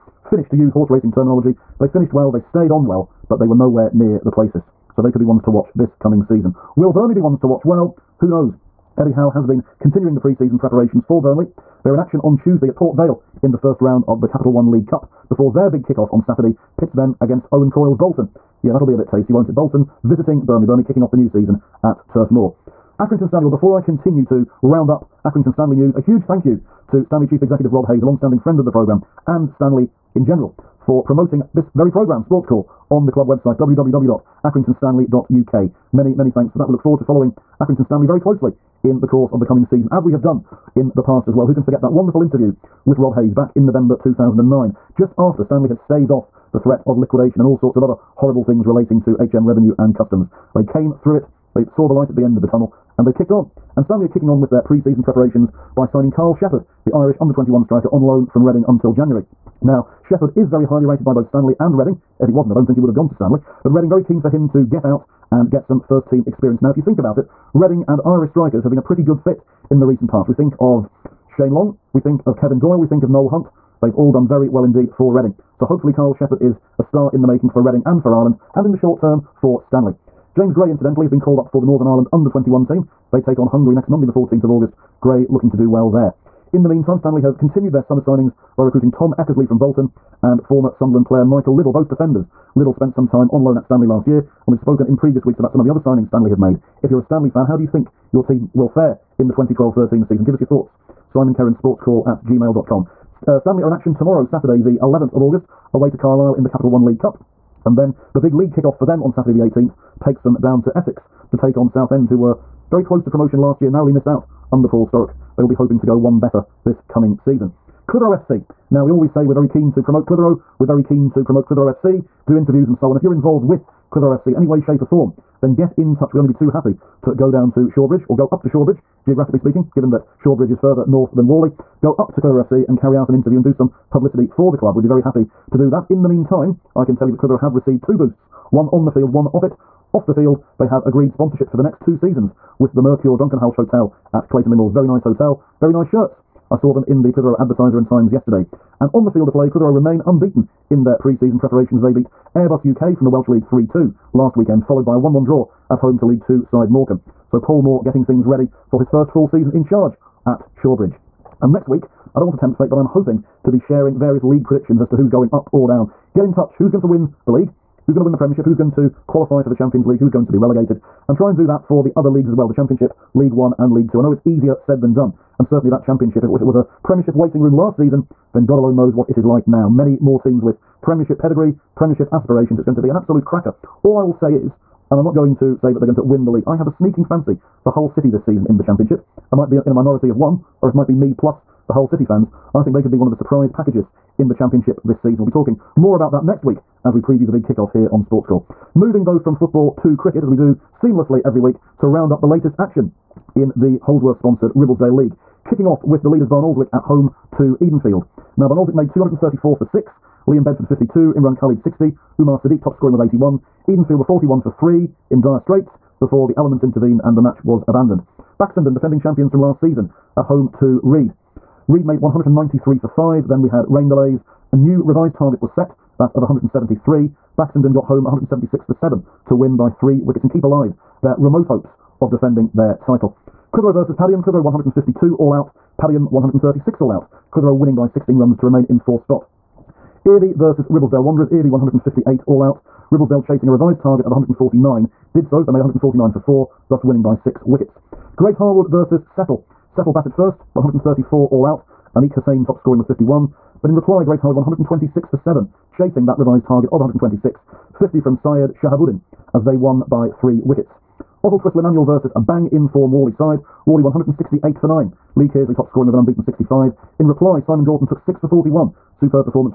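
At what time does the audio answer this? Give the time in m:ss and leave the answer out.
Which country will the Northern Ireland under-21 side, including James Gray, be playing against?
1:23.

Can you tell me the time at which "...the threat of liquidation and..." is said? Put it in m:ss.
0:46.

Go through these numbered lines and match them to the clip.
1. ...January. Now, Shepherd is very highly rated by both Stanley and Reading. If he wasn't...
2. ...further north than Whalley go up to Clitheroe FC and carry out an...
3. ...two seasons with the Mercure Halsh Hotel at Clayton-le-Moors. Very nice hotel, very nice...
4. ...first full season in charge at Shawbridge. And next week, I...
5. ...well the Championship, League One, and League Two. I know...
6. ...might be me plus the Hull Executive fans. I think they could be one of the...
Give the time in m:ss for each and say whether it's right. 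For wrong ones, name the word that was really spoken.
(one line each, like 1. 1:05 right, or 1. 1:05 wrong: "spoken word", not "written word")
1. 0:58 right
2. 2:10 right
3. 2:21 right
4. 2:38 right
5. 2:52 right
6. 3:10 wrong: "City", not "Executive".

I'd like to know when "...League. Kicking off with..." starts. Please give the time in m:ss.
3:24.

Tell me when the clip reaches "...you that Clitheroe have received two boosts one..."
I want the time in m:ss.
2:17.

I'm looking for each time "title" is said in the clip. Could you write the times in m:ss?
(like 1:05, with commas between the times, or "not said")
3:52.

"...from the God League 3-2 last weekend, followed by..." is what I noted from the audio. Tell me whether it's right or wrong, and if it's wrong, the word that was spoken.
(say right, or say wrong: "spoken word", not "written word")
wrong: "Welsh", not "God".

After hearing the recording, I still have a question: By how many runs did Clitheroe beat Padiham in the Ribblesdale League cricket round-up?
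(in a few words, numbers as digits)
16.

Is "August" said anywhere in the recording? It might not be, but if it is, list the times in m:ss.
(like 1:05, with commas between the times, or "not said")
1:24, 1:45.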